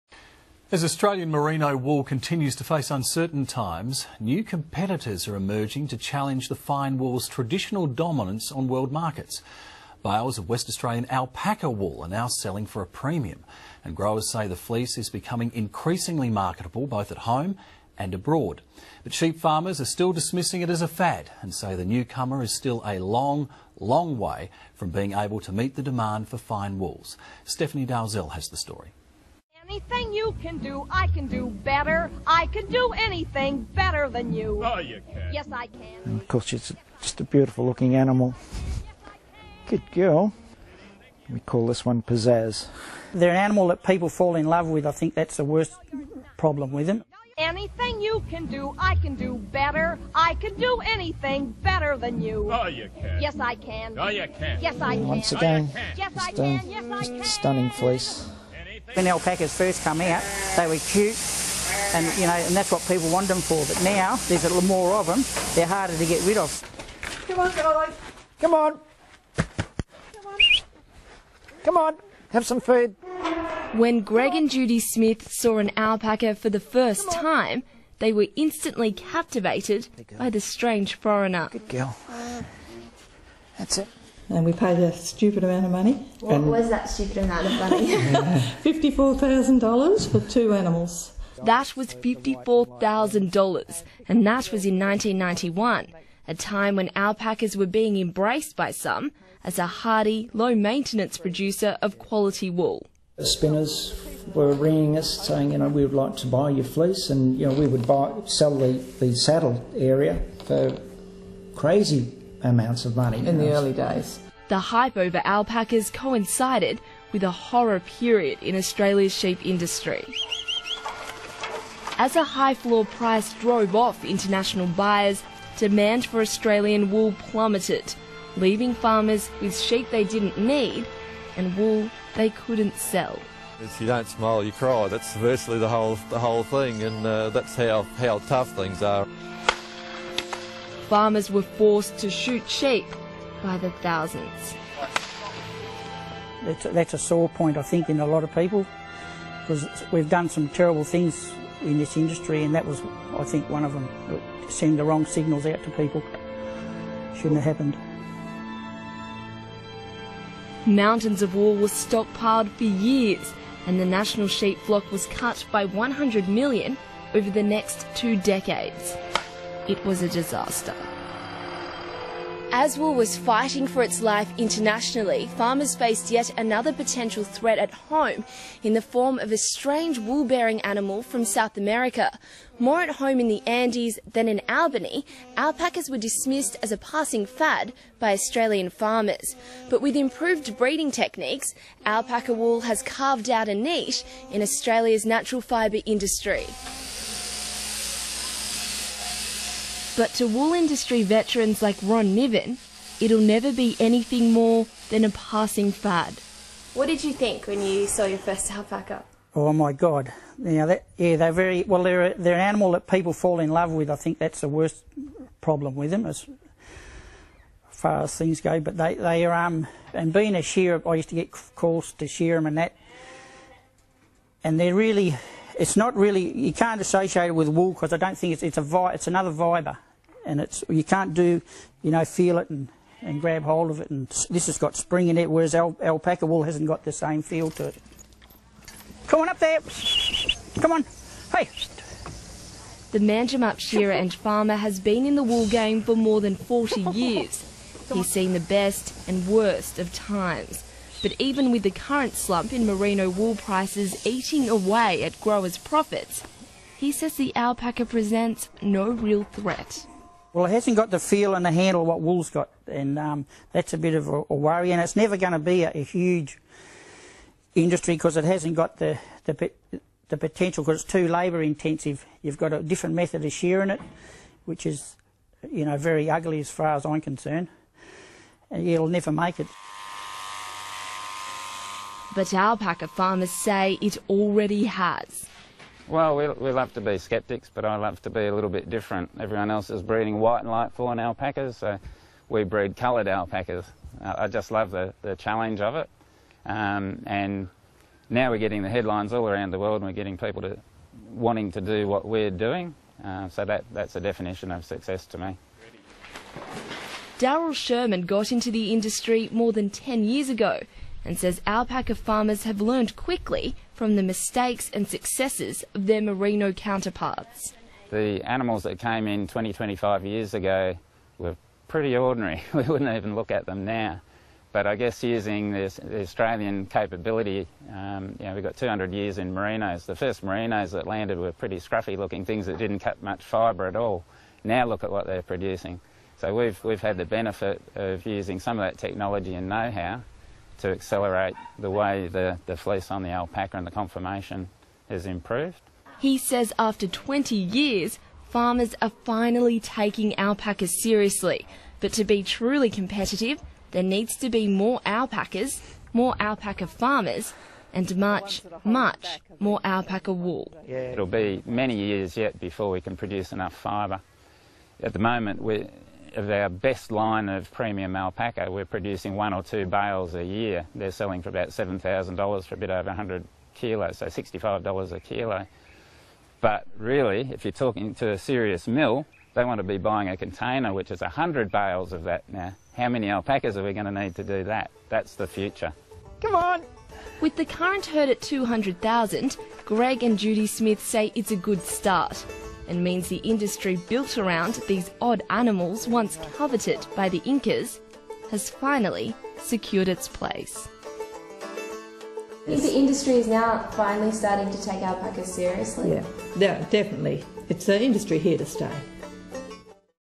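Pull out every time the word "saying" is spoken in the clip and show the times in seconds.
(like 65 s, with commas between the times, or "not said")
105 s.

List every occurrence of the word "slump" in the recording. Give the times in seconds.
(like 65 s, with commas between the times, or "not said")
252 s.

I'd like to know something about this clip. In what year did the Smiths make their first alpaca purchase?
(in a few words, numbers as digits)
1991.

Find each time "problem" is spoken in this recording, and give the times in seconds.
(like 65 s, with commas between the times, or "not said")
46 s, 215 s.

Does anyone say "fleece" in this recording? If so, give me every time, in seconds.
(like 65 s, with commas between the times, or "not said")
14 s, 57 s, 106 s, 342 s.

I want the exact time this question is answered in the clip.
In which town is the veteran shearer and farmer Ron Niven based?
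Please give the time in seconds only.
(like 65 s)
242 s.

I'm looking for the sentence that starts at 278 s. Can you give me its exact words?
And it'll never make it but alpaca farmers say it already has.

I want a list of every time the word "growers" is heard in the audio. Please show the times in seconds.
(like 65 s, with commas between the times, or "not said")
13 s, 255 s.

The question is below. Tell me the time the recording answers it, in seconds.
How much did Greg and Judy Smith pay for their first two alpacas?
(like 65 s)
88 s.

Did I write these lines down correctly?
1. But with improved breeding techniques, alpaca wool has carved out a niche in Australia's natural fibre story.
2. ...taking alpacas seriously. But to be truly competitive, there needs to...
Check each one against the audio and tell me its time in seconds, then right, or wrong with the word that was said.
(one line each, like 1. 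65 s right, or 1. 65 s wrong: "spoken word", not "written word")
1. 189 s wrong: "industry", not "story"
2. 349 s right.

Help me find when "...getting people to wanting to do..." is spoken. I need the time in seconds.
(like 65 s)
299 s.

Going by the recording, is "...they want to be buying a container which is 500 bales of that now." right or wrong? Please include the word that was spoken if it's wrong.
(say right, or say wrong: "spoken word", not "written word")
wrong: "100", not "500".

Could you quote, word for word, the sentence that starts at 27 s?
Stephanie Dalzell has the story anything you can do, I can do better.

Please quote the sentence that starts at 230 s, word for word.
And it's, you can't do, you know, feel it and, and grab hold of it.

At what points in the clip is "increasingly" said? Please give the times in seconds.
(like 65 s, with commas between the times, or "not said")
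15 s.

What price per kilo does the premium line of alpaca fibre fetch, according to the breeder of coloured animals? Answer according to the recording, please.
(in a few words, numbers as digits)
$65.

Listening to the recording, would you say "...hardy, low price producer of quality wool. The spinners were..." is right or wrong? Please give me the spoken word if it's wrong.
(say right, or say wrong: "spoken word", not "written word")
wrong: "maintenance", not "price".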